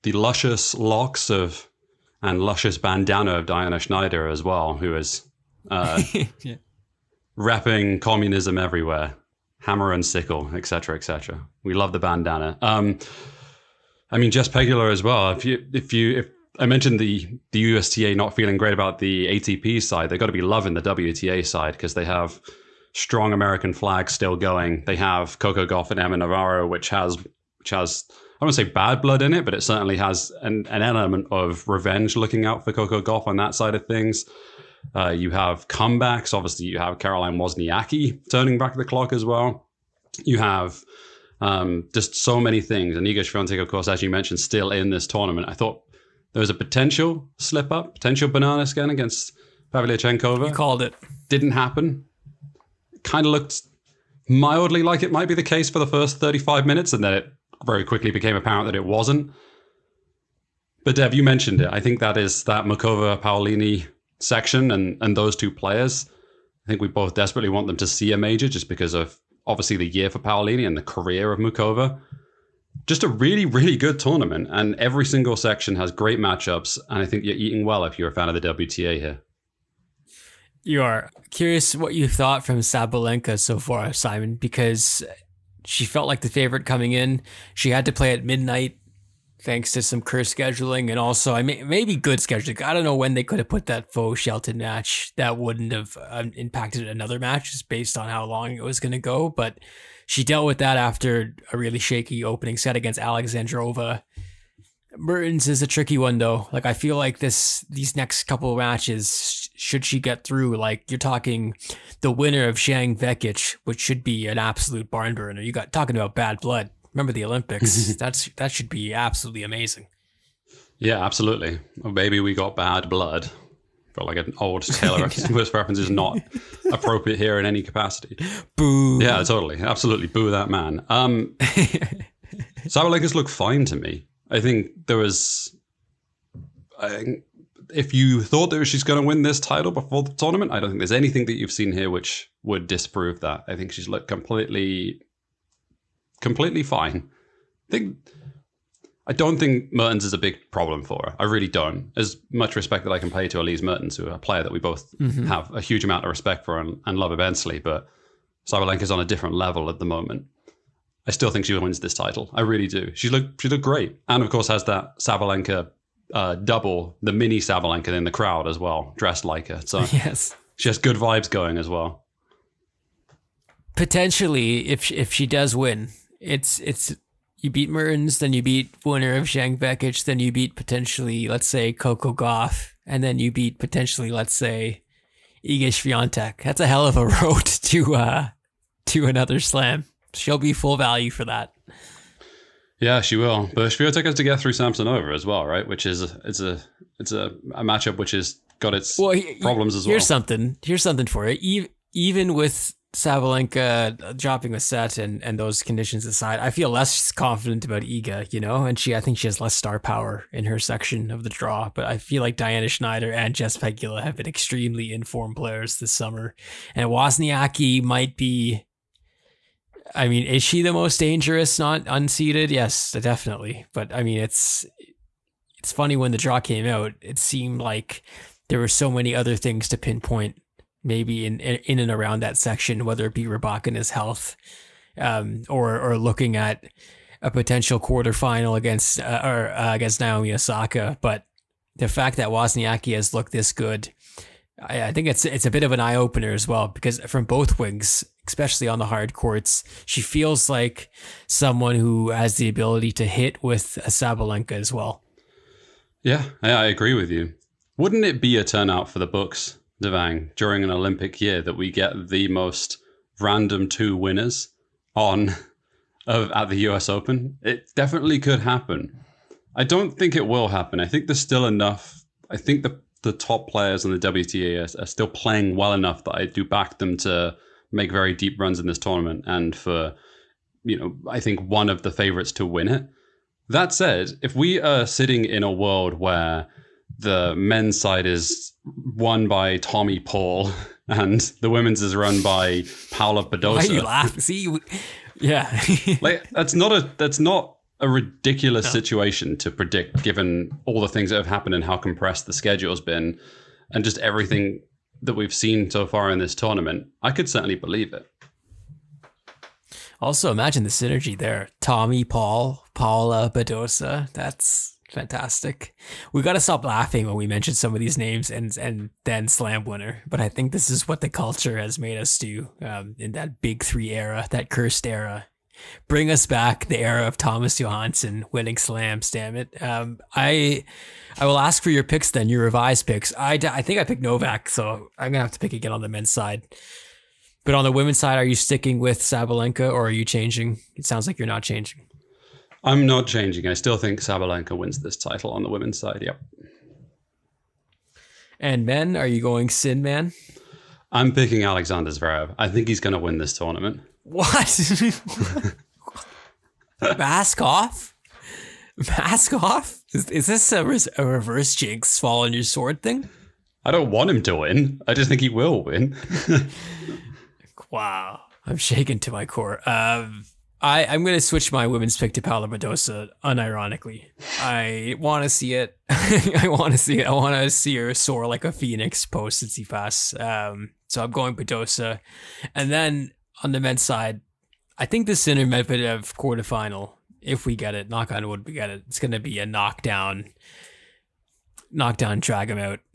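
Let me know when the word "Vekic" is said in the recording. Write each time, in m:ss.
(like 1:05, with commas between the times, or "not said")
1:52, 2:59.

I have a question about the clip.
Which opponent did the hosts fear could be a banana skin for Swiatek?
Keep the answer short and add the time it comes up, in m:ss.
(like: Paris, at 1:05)
Pavlyuchenkova, at 0:49.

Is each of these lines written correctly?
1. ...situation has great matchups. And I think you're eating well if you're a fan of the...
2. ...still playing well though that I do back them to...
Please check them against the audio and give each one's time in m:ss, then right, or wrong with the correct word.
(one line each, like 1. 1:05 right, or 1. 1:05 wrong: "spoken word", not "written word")
1. 1:15 wrong: "section", not "situation"
2. 4:34 wrong: "enough", not "though".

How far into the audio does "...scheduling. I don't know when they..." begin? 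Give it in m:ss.
1:32.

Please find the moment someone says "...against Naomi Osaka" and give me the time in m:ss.
3:59.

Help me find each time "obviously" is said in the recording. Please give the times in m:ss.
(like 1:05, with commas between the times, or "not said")
0:36, 1:09.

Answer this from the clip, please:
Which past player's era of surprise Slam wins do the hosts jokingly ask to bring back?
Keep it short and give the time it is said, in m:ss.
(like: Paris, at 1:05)
Thomas Johansson, at 5:27.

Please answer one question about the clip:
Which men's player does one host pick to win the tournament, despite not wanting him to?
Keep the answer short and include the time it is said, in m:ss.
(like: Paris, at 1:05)
Alexander Zverev, at 5:51.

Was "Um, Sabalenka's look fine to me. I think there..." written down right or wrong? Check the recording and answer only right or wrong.
right.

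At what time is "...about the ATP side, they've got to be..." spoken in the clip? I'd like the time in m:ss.
0:18.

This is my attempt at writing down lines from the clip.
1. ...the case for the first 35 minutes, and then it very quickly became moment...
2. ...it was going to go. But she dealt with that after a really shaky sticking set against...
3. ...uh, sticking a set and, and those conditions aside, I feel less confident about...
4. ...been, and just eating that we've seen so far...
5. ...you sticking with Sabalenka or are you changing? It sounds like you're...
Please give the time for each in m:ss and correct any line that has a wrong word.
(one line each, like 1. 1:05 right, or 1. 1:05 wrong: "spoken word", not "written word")
1. 0:55 wrong: "apparent", not "moment"
2. 1:38 wrong: "opening", not "sticking"
3. 3:24 wrong: "dropping", not "sticking"
4. 5:02 wrong: "everything", not "eating"
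5. 5:38 right.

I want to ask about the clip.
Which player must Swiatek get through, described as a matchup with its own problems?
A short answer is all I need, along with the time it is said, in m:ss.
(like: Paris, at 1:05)
Samsonova, at 3:14.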